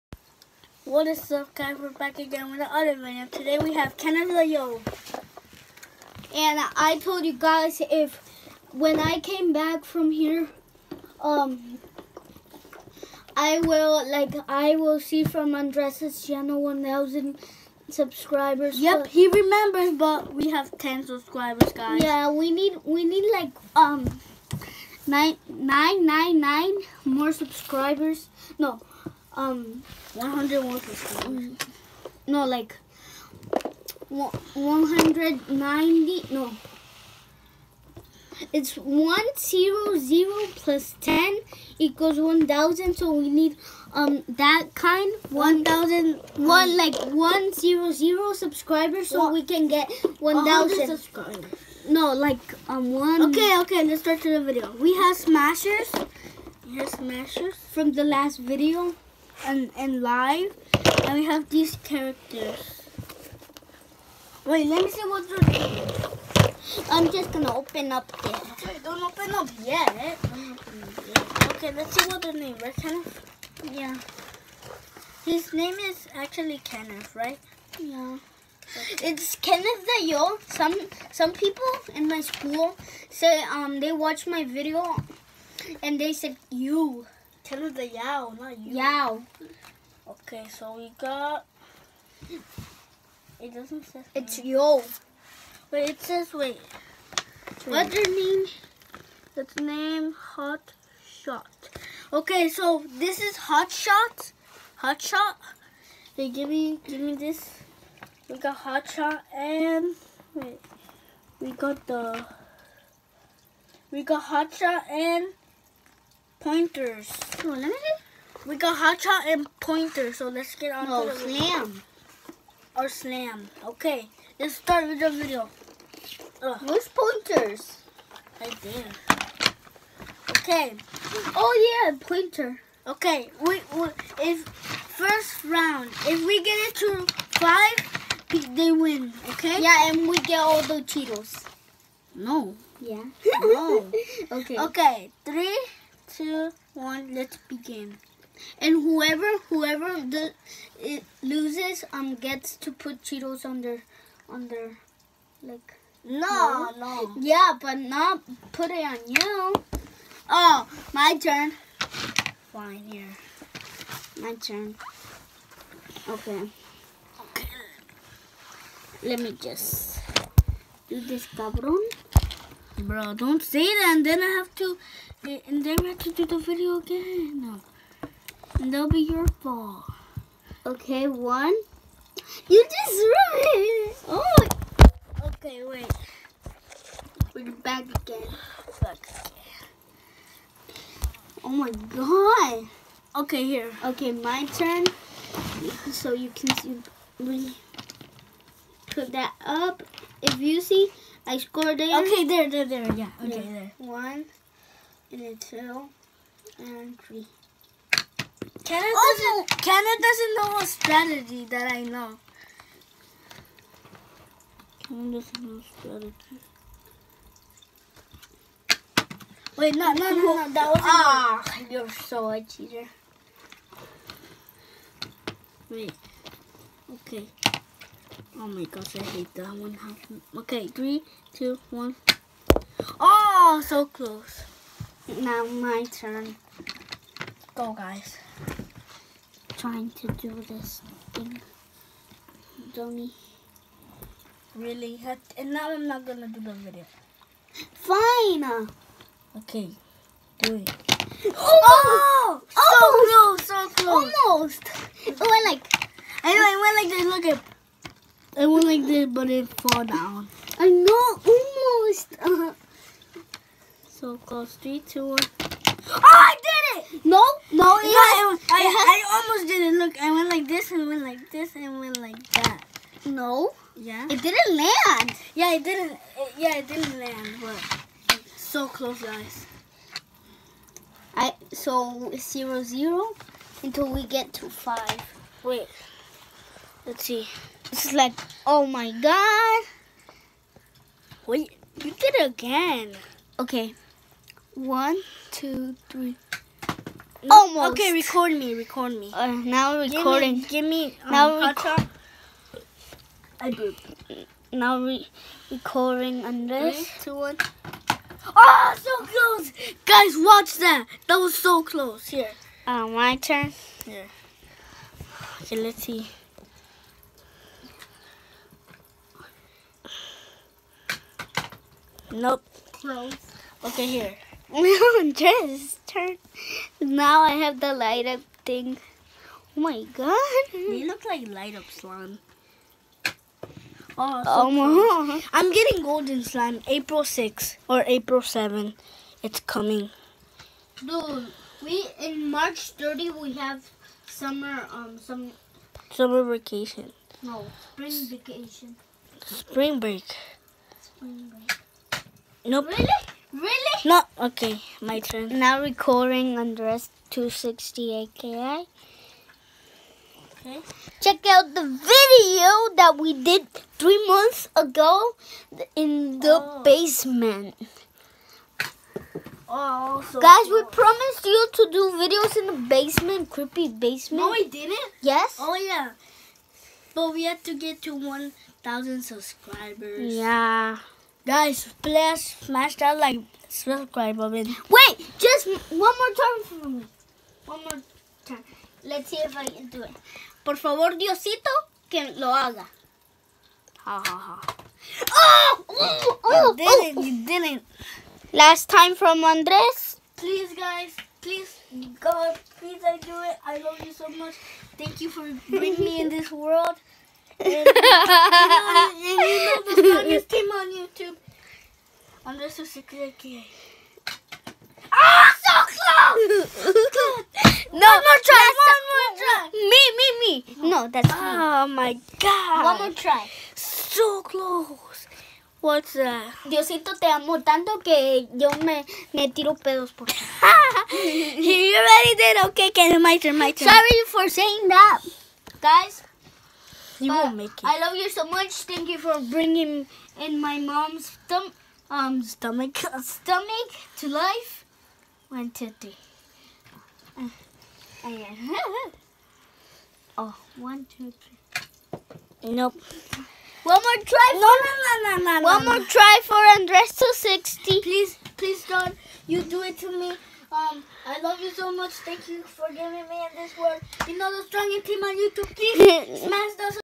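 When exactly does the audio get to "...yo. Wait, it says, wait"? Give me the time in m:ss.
1:34.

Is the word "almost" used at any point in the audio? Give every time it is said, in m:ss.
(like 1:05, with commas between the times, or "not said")
4:14, 4:21, 4:29, 4:57.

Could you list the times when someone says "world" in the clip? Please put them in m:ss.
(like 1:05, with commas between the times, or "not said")
6:46, 7:43.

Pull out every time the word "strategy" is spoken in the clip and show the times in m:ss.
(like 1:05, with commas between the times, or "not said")
3:30, 3:35.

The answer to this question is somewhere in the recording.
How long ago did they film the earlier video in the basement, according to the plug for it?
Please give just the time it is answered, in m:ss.
6:03.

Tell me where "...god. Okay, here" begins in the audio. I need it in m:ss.
3:11.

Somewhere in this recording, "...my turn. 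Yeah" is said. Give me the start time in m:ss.
5:12.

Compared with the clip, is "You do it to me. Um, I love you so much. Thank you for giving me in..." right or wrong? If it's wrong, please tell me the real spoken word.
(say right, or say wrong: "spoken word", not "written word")
right.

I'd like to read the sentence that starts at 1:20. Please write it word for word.
Some some people in my school say um they watch my video and they said you Tell us the Yao, not you.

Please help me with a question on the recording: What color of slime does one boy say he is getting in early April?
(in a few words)
Golden.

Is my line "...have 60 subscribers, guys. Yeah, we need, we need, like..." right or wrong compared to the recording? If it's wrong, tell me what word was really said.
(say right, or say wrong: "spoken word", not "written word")
wrong: "10", not "60".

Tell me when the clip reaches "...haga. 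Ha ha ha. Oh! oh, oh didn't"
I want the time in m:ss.
6:32.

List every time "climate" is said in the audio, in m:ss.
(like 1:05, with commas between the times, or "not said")
not said.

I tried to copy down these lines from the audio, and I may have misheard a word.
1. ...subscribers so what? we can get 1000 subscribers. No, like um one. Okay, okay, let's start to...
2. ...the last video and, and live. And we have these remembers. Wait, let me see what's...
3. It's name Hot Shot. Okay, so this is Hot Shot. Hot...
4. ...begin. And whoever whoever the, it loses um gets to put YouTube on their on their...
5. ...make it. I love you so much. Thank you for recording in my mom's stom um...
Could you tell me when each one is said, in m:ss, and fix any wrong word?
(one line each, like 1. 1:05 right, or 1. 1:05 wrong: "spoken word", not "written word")
1. 0:48 right
2. 0:57 wrong: "characters", not "remembers"
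3. 1:39 right
4. 2:27 wrong: "Cheetos", not "YouTube"
5. 7:17 wrong: "bringing", not "recording".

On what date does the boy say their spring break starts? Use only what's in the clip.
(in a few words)
March 30.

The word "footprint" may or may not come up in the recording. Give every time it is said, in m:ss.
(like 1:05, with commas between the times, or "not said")
not said.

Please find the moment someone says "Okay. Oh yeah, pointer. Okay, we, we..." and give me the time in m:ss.
2:10.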